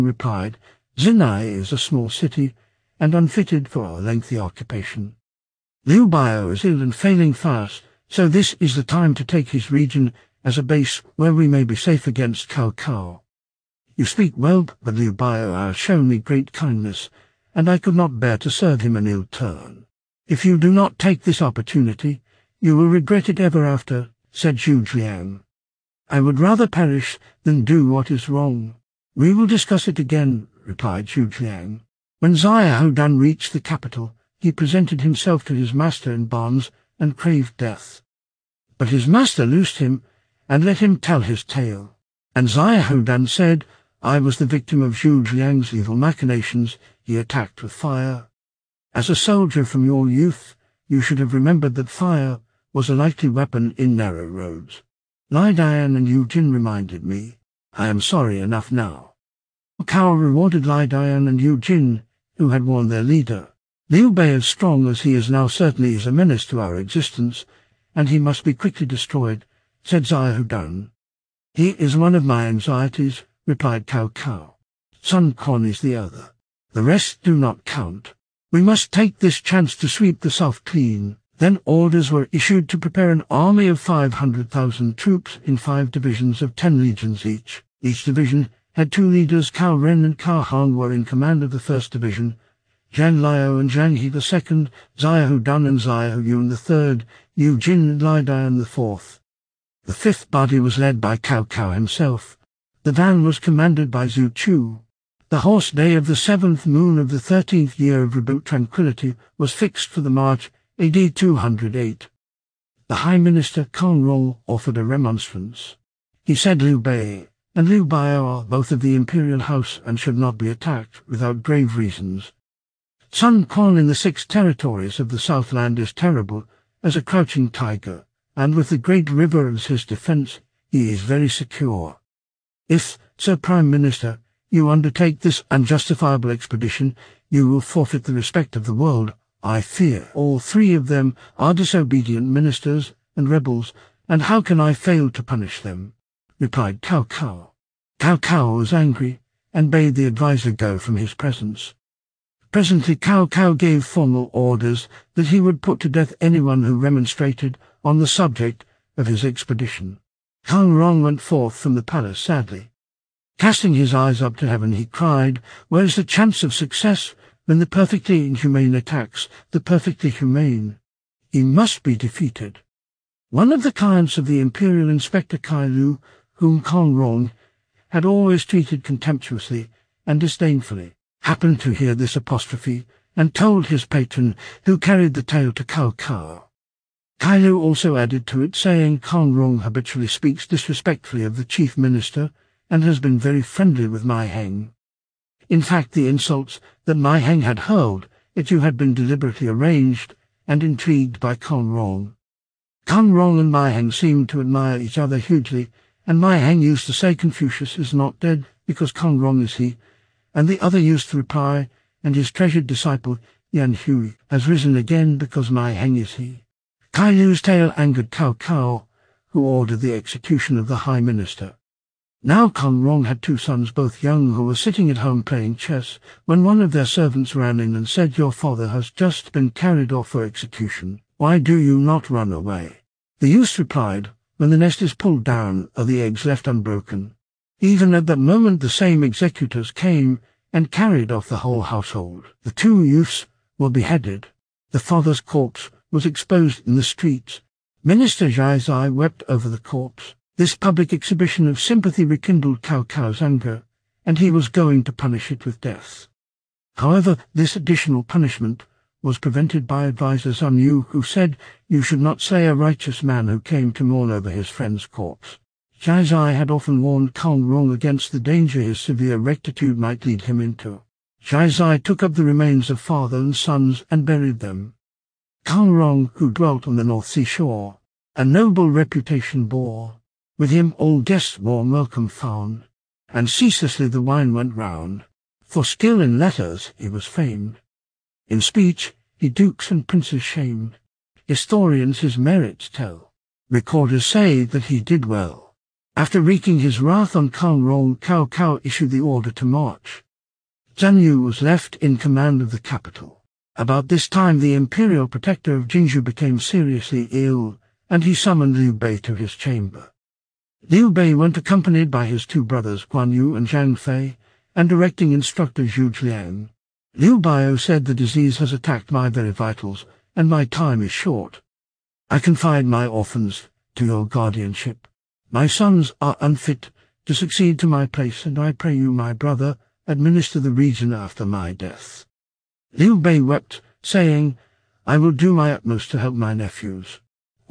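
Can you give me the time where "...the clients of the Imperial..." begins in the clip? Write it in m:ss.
2:53.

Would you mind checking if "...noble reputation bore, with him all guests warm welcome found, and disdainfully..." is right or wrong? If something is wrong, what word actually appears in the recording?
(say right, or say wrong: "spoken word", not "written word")
wrong: "ceaselessly", not "disdainfully".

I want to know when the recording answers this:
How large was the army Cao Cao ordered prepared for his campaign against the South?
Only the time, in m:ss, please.
1:23.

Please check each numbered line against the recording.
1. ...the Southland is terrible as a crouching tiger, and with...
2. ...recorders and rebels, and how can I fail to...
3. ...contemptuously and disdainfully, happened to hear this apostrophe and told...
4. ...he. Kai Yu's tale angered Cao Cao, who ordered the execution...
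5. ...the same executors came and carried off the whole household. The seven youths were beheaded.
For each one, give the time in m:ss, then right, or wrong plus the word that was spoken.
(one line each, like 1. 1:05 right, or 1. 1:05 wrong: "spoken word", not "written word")
1. 2:05 right
2. 2:22 wrong: "ministers", not "recorders"
3. 2:58 right
4. 3:36 right
5. 3:58 wrong: "two", not "seven".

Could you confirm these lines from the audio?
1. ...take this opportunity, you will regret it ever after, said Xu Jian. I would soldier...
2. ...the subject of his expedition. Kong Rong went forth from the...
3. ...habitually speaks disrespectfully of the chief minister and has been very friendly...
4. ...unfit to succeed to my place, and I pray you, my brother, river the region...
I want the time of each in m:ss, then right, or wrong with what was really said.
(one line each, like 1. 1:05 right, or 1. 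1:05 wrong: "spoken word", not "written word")
1. 0:20 wrong: "rather", not "soldier"
2. 2:37 right
3. 3:09 right
4. 5:26 wrong: "administer", not "river".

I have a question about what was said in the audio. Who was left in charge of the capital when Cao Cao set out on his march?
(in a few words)
Zhang Yu.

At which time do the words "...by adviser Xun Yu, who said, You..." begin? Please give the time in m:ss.
4:19.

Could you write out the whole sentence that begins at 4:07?
Minister Jaizai wept over the corpse.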